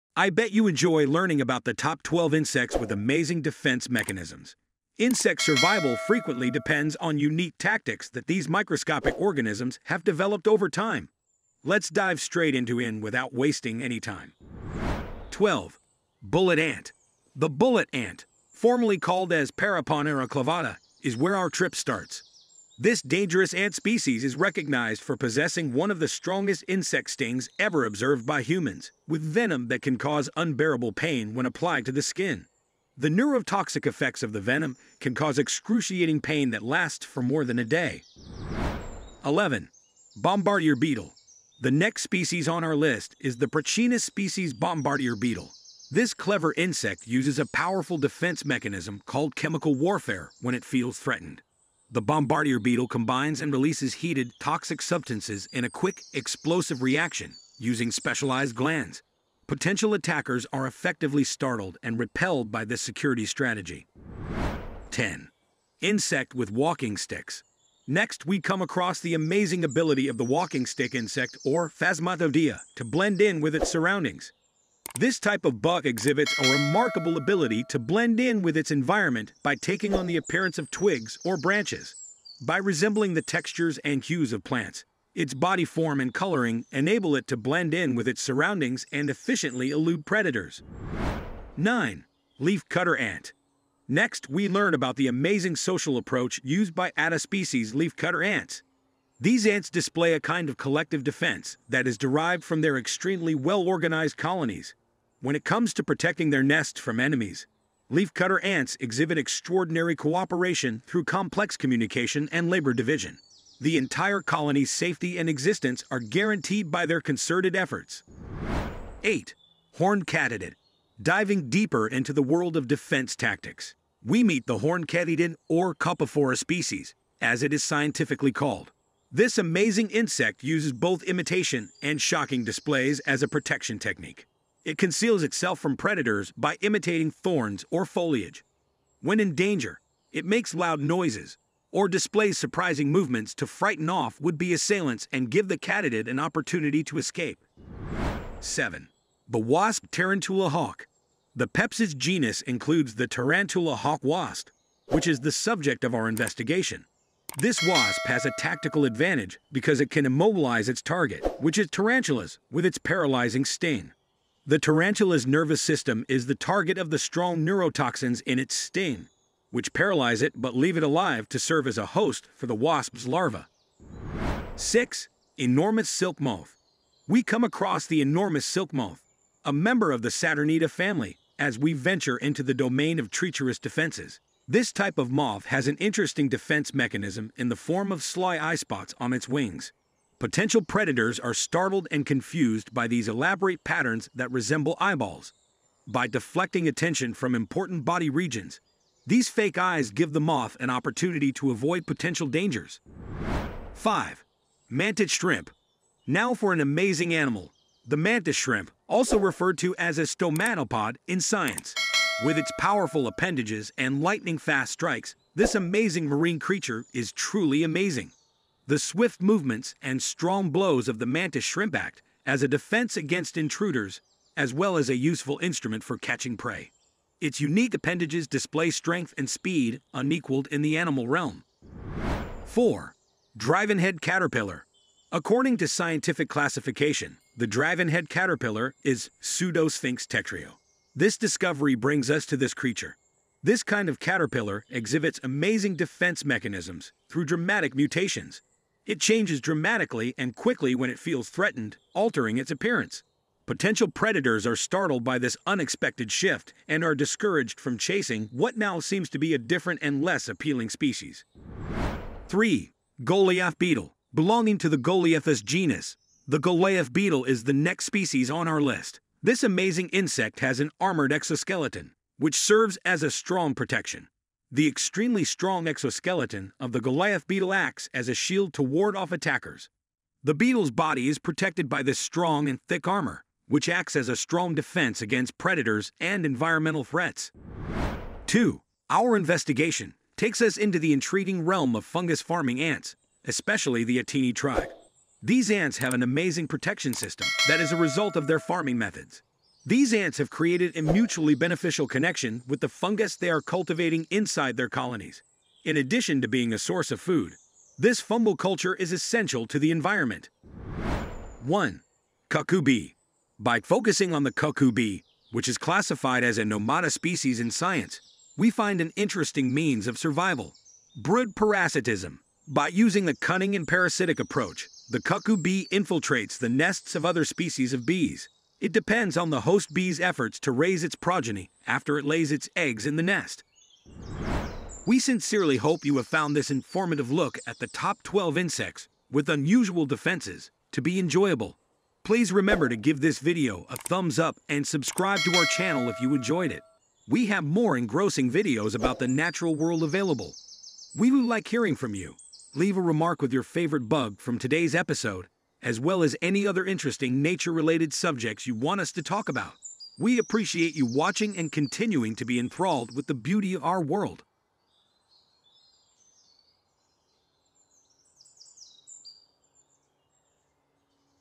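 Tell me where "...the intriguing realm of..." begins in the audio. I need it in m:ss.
4:50.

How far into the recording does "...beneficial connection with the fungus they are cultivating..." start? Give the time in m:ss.
5:01.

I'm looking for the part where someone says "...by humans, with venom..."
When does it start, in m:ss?
0:28.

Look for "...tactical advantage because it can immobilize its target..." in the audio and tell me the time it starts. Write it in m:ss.
2:38.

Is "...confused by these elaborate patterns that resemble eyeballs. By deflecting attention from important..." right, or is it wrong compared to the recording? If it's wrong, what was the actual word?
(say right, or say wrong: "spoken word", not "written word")
right.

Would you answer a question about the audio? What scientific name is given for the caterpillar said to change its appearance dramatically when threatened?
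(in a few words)
Pseudosphinx tetrio.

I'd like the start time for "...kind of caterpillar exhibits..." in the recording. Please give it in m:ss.
4:03.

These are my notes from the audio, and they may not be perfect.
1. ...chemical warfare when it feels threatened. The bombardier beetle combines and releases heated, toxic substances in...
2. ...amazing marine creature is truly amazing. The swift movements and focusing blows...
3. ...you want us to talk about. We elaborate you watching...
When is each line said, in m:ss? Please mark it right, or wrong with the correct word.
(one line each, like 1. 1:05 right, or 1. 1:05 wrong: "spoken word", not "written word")
1. 0:49 right
2. 3:35 wrong: "strong", not "focusing"
3. 5:58 wrong: "appreciate", not "elaborate".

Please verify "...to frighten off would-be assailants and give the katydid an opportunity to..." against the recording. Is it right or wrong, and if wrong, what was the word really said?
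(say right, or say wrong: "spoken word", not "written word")
right.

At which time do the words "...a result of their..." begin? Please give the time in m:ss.
4:57.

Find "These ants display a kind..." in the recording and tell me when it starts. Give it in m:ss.
1:39.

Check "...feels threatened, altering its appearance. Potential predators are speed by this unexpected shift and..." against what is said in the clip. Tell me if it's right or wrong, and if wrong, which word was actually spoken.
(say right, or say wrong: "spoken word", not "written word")
wrong: "startled", not "speed".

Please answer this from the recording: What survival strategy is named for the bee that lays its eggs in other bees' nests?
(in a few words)
Brood parasitism.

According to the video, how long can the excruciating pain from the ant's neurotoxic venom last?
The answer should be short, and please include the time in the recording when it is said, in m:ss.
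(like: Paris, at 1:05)
more than a day, at 0:37.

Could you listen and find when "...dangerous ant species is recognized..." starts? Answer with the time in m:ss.
0:23.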